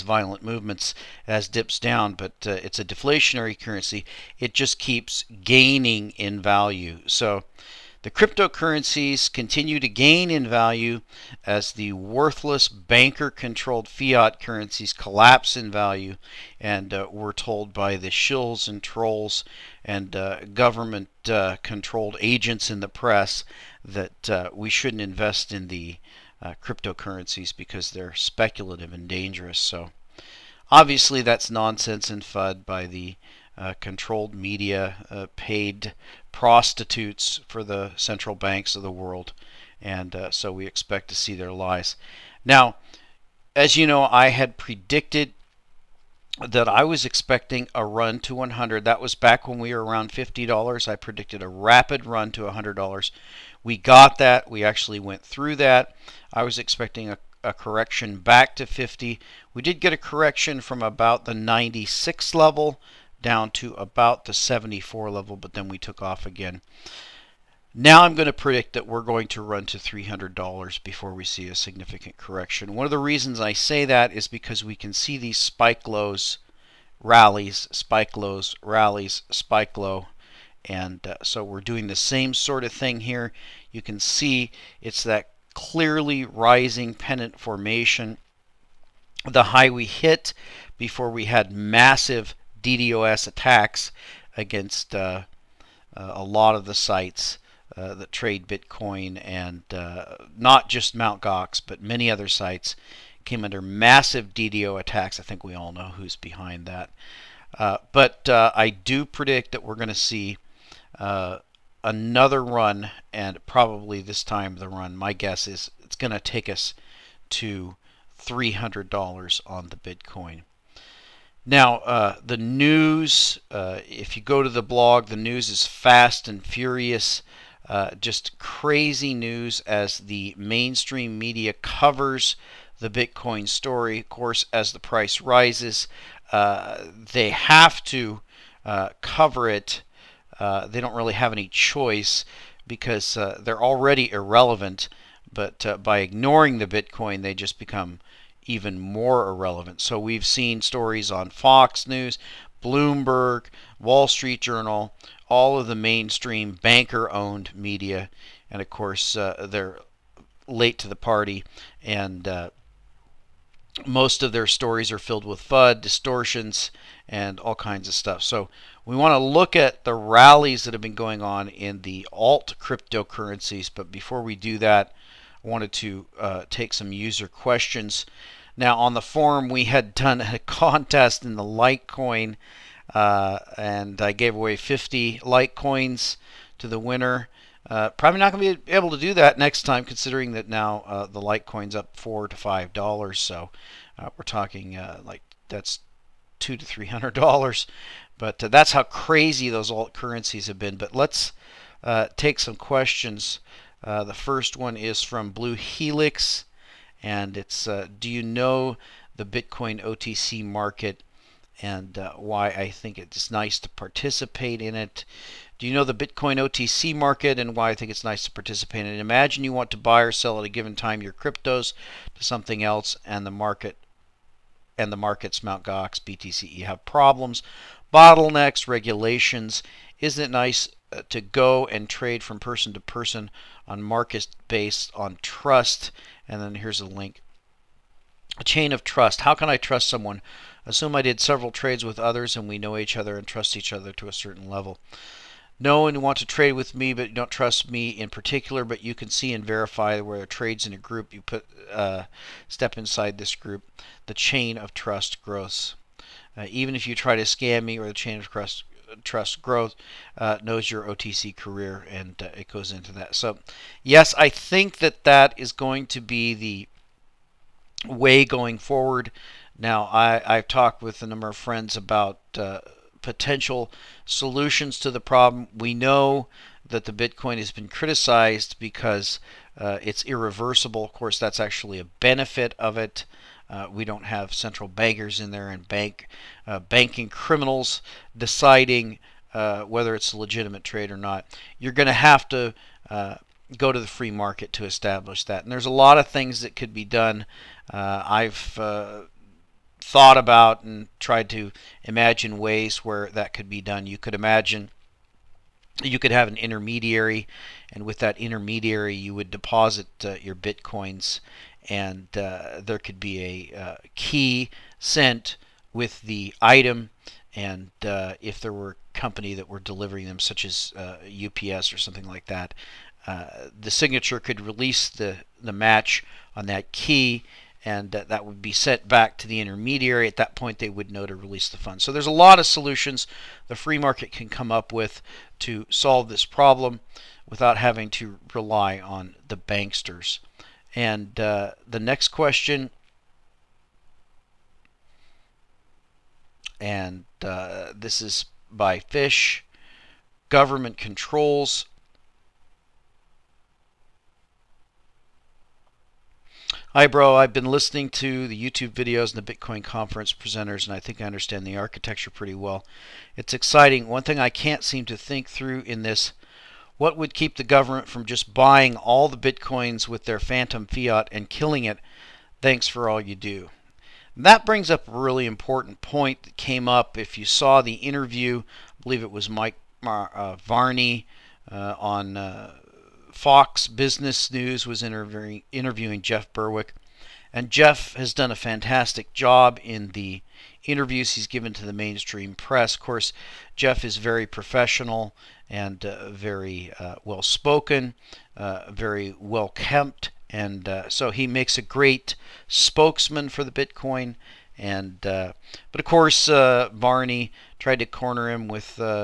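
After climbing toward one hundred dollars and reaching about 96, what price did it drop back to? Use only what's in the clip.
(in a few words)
74.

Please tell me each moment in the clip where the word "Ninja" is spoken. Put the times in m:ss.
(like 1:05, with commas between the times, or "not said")
not said.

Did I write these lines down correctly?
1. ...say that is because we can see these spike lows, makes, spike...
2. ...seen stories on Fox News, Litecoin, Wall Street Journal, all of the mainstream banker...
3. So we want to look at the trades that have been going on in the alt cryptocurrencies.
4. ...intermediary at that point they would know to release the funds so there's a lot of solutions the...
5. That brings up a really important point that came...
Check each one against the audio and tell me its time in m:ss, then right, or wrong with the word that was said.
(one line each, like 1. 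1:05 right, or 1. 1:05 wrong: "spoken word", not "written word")
1. 1:13 wrong: "rallies", not "makes"
2. 2:30 wrong: "Bloomberg", not "Litecoin"
3. 2:48 wrong: "rallies", not "trades"
4. 5:29 right
5. 6:14 right.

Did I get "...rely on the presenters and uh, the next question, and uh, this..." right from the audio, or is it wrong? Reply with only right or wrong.
wrong.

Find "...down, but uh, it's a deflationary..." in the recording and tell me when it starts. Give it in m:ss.
0:01.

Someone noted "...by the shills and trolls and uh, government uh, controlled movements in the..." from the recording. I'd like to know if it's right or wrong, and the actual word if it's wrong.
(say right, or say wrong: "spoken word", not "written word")
wrong: "agents", not "movements".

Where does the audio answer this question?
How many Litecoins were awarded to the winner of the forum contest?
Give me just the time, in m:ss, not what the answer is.
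3:04.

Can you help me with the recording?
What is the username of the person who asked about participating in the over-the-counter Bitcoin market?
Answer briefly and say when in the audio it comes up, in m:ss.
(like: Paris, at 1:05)
Blue Helix, at 3:25.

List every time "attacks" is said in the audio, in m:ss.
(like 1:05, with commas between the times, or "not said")
1:33, 1:44.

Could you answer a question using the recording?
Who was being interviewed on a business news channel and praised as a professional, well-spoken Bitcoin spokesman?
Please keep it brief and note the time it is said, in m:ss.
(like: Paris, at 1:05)
Jeff Berwick, at 6:25.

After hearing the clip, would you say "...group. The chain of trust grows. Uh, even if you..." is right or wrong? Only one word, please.
right.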